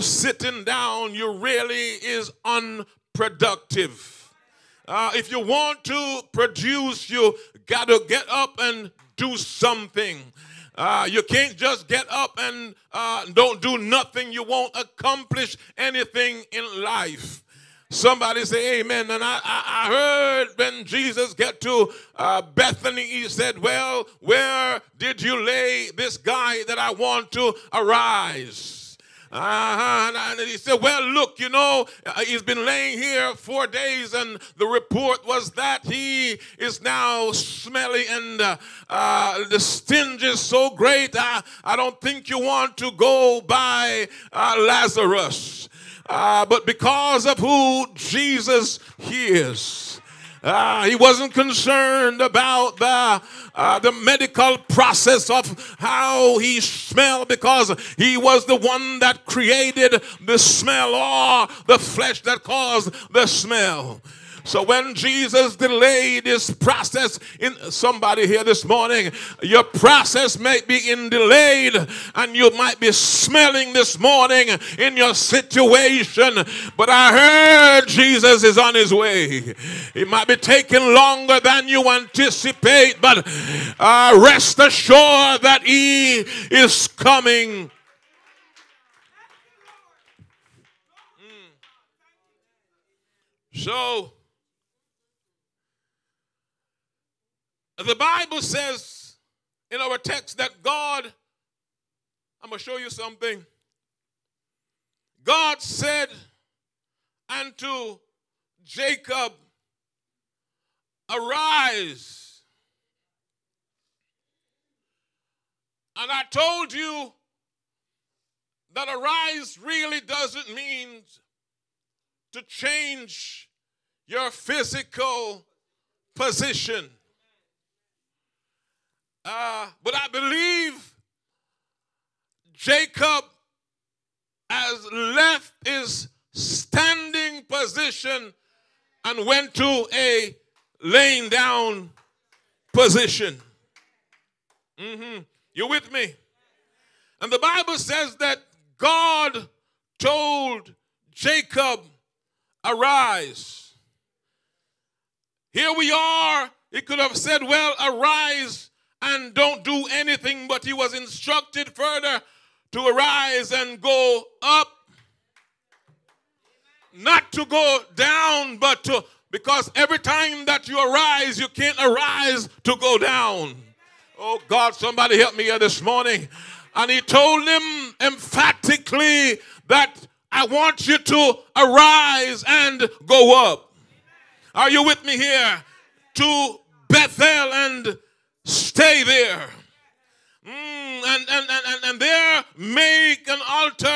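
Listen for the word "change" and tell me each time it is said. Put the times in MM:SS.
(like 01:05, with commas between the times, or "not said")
02:02.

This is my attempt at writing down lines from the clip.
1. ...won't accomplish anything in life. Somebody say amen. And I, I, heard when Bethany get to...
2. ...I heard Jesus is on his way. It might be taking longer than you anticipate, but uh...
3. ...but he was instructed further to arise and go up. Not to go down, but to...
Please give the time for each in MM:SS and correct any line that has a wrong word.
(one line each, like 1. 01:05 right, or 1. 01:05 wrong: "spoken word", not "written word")
1. 00:14 wrong: "Jesus", not "Bethany"
2. 01:16 right
3. 02:40 right.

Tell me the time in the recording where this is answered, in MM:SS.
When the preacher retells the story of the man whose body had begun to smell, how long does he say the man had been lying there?
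00:33.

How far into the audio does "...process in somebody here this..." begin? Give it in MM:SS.
01:06.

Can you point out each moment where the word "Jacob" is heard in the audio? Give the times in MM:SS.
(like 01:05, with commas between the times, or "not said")
01:48, 02:12, 02:31.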